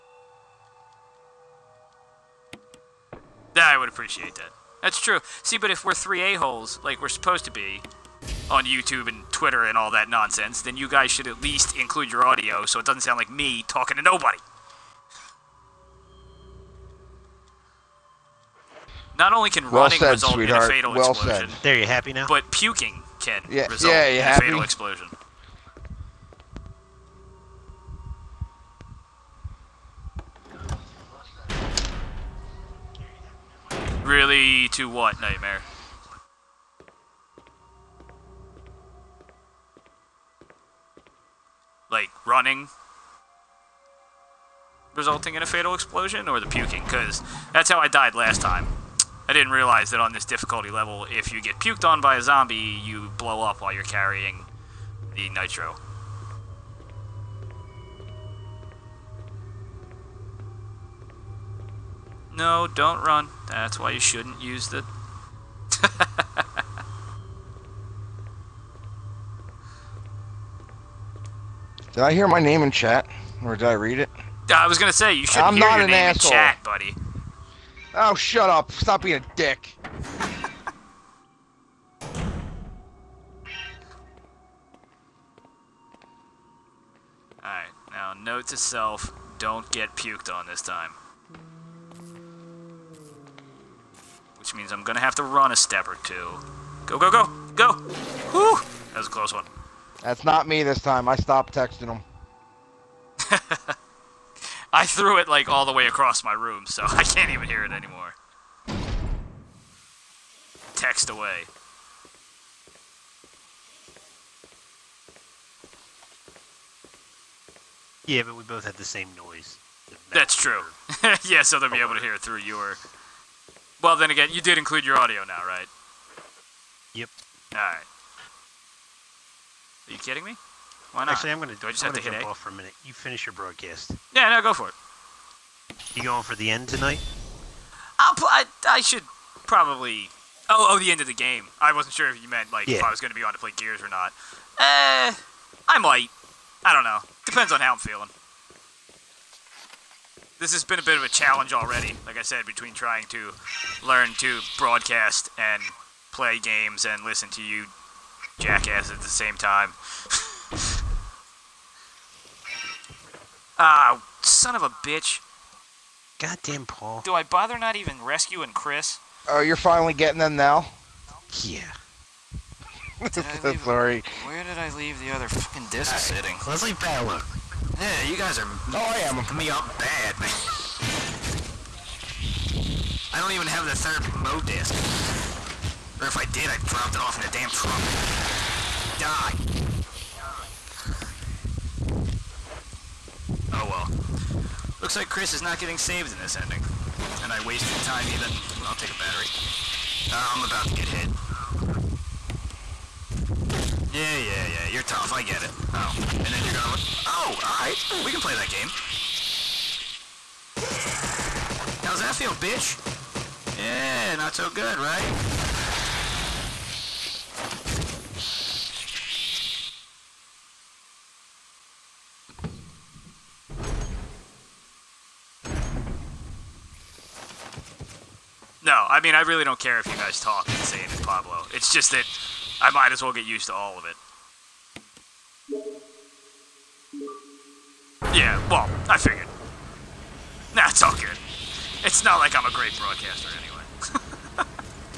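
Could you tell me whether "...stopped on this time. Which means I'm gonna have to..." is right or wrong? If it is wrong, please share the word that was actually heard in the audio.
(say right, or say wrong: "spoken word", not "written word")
wrong: "puked", not "stopped".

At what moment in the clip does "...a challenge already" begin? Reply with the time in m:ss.
2:31.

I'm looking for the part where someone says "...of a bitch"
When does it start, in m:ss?
2:44.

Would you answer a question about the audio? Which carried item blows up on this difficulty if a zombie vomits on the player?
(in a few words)
Nitro.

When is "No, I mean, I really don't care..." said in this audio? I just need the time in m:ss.
3:48.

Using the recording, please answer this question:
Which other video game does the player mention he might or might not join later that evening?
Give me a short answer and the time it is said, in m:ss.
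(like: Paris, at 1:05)
Gears, at 2:23.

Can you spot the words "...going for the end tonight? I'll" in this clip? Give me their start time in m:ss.
2:16.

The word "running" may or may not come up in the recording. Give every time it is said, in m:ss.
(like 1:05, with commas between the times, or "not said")
0:19, 0:42.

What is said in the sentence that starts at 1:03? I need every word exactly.
That's why you shouldn't use the Did I hear my name in chat?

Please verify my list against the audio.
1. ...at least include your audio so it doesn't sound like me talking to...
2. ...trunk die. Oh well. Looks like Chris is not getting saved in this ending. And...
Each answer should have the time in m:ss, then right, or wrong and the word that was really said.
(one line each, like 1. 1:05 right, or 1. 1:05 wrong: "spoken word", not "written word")
1. 0:11 right
2. 3:07 right.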